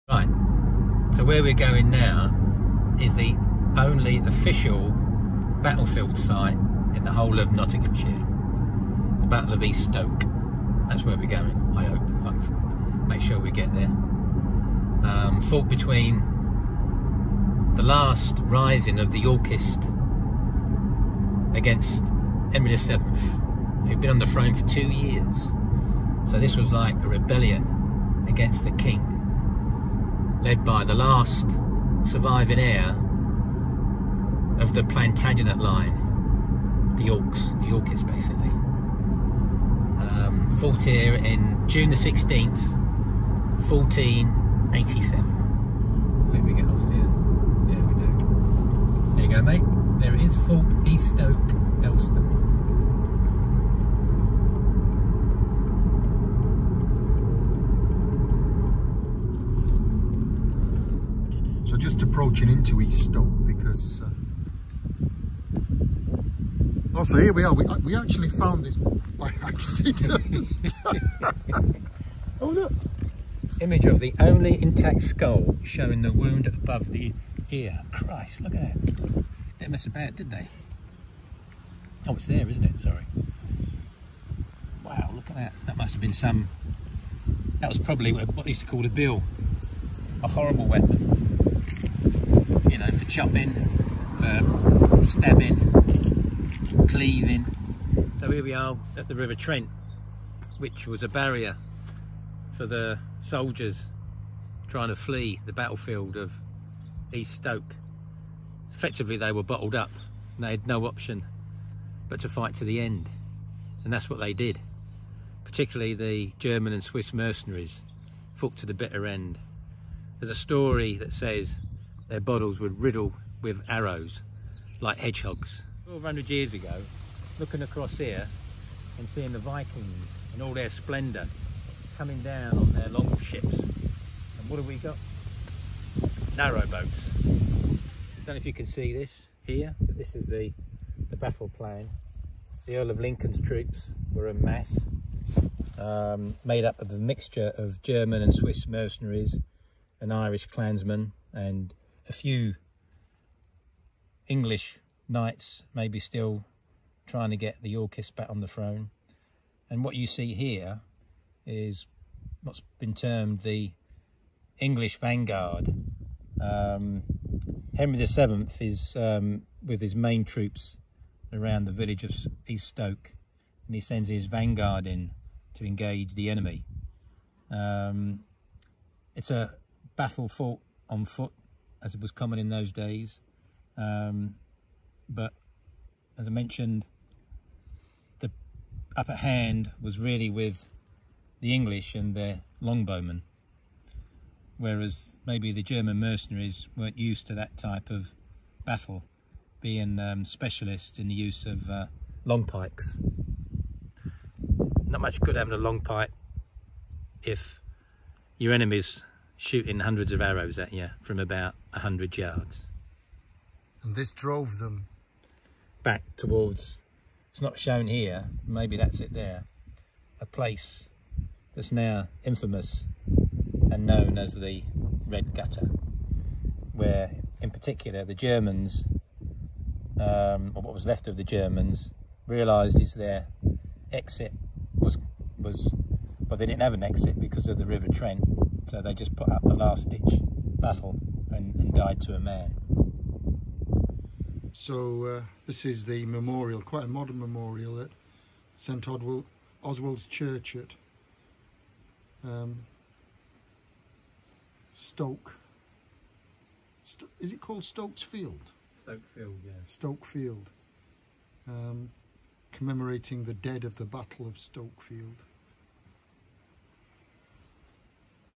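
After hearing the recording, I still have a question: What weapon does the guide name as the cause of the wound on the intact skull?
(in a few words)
A bill.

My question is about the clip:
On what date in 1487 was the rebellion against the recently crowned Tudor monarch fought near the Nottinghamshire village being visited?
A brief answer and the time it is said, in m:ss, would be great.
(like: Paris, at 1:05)
June 16, at 0:41.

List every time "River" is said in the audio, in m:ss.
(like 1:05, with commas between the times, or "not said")
1:39, 3:57.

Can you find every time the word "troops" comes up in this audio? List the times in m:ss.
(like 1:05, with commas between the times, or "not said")
2:23, 2:50.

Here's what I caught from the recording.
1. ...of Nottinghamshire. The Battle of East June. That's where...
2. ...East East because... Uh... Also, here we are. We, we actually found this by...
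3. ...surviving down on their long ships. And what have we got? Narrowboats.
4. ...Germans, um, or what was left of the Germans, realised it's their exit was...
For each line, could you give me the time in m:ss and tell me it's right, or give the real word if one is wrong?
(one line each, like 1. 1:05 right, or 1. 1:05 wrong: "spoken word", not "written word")
1. 0:07 wrong: "Stoke", not "June"
2. 1:02 wrong: "Stoke", not "East"
3. 2:11 wrong: "coming", not "surviving"
4. 3:48 right.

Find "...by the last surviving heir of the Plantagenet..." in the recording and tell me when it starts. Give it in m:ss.
0:30.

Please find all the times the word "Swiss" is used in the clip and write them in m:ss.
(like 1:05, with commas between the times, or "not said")
1:56, 2:28.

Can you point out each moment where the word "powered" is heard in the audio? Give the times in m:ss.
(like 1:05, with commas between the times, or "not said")
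not said.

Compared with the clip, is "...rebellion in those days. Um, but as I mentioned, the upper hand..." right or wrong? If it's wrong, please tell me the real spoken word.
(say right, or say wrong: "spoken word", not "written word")
wrong: "common", not "rebellion".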